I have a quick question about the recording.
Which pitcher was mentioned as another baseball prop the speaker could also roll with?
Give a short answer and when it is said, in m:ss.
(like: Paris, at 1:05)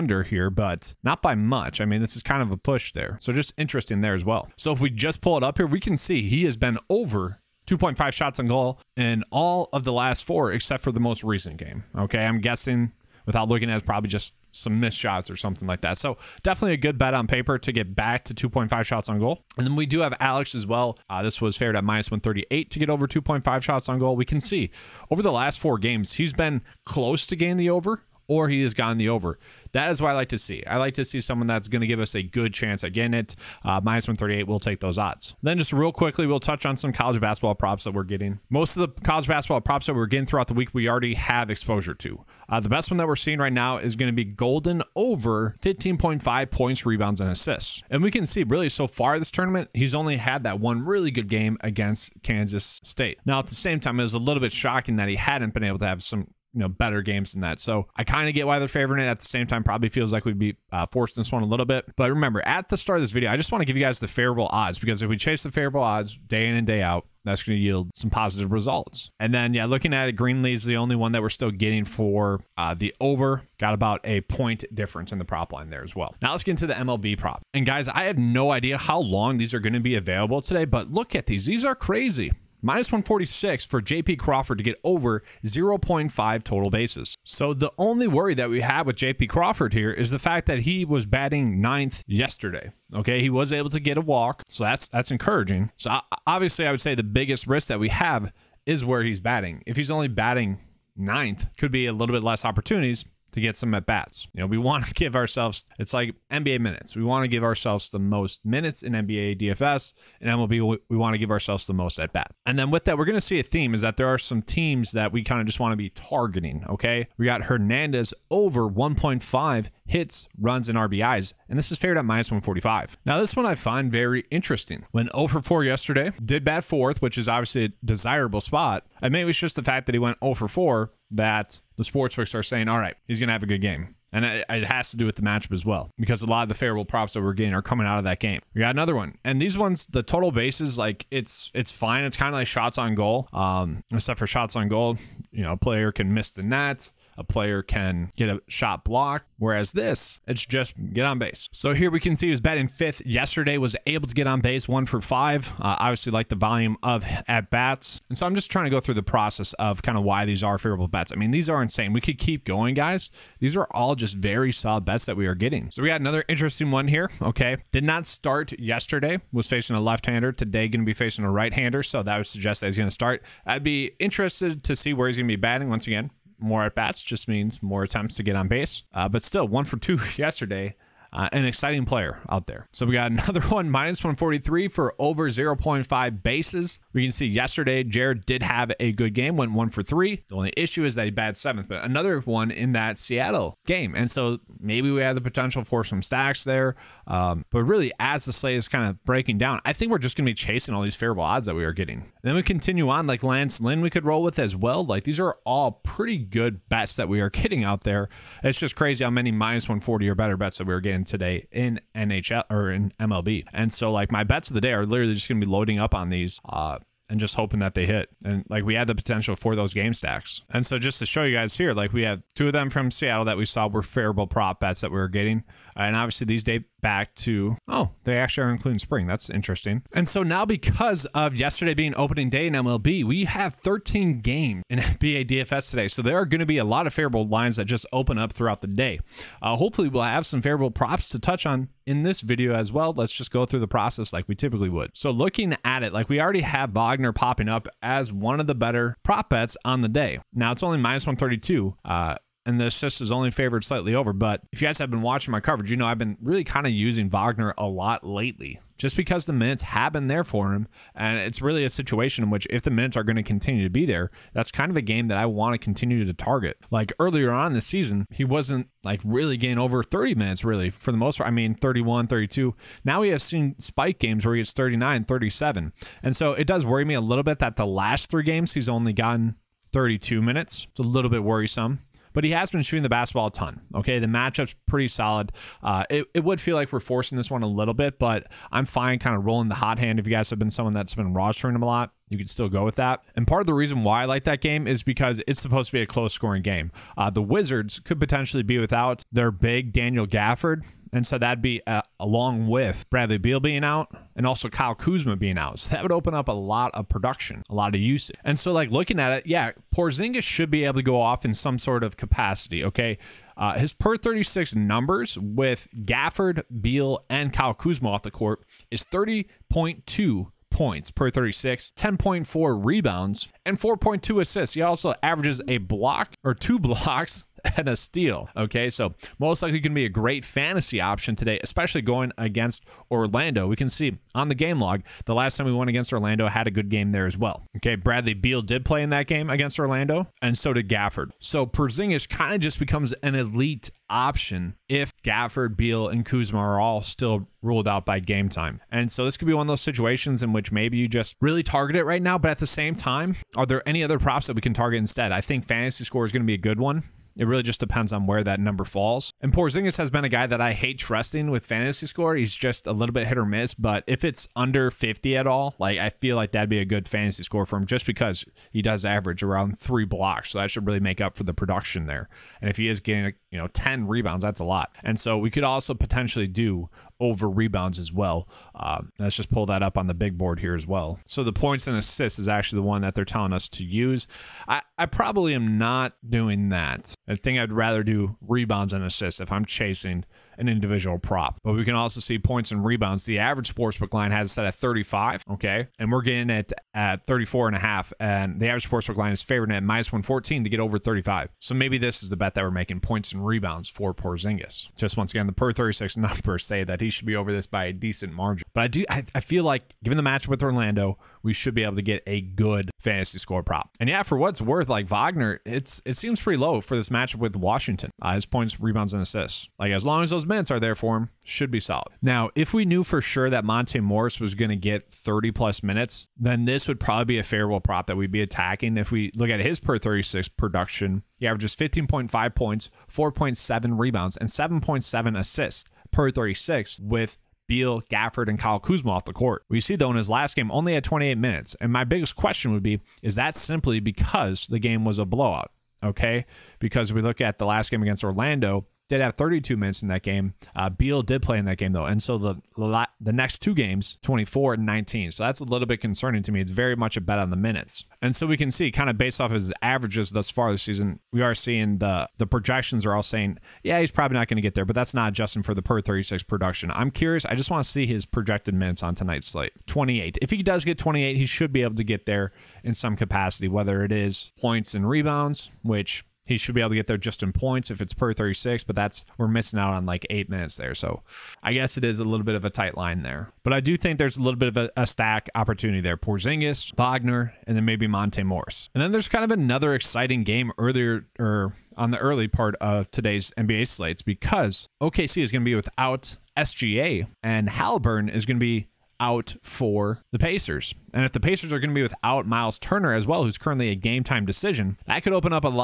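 Lance Lynn, at 3:23.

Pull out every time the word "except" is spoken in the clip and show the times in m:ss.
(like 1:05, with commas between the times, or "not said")
0:10, 2:23.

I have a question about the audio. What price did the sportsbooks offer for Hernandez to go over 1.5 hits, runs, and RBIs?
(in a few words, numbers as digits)
-145.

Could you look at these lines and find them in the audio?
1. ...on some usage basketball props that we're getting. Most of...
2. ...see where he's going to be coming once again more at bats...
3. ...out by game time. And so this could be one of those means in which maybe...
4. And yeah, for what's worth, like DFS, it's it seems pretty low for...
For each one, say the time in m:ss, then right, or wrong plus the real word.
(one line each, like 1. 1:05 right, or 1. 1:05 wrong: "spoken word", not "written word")
1. 0:36 wrong: "college", not "usage"
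2. 2:54 wrong: "batting", not "coming"
3. 5:47 wrong: "situations", not "means"
4. 6:53 wrong: "Wagner", not "DFS".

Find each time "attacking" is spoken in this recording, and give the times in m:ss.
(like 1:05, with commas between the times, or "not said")
7:08.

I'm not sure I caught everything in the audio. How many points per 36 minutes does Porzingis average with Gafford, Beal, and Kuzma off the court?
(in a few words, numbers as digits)
30.2.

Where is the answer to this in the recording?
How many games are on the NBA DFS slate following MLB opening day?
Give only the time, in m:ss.
3:53.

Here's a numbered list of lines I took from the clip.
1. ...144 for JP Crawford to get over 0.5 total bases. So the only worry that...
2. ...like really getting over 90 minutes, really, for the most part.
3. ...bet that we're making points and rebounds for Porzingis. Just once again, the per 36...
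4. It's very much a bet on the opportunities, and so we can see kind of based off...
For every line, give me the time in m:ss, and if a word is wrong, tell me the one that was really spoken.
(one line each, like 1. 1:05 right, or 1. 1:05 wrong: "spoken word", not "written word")
1. 1:22 wrong: "146", not "144"
2. 4:28 wrong: "30", not "90"
3. 6:42 right
4. 7:36 wrong: "minutes", not "opportunities".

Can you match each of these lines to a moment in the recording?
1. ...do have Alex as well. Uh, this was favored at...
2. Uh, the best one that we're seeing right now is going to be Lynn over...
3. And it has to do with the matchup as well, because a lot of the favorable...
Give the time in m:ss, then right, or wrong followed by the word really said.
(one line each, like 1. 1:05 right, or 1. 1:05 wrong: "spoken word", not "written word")
1. 0:19 right
2. 0:42 wrong: "Golden", not "Lynn"
3. 2:14 right.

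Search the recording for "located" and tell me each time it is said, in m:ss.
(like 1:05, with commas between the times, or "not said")
not said.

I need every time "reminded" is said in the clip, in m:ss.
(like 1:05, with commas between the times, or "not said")
not said.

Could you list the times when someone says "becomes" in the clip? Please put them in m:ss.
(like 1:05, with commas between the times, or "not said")
5:42.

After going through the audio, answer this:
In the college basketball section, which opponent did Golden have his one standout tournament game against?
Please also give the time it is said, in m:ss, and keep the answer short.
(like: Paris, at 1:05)
Kansas State, at 0:52.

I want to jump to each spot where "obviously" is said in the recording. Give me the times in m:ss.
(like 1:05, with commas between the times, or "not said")
1:36, 2:07, 2:35, 3:45.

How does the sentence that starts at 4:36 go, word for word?
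And so it does worry me a little bit that the last three games he's only gotten 32 minutes.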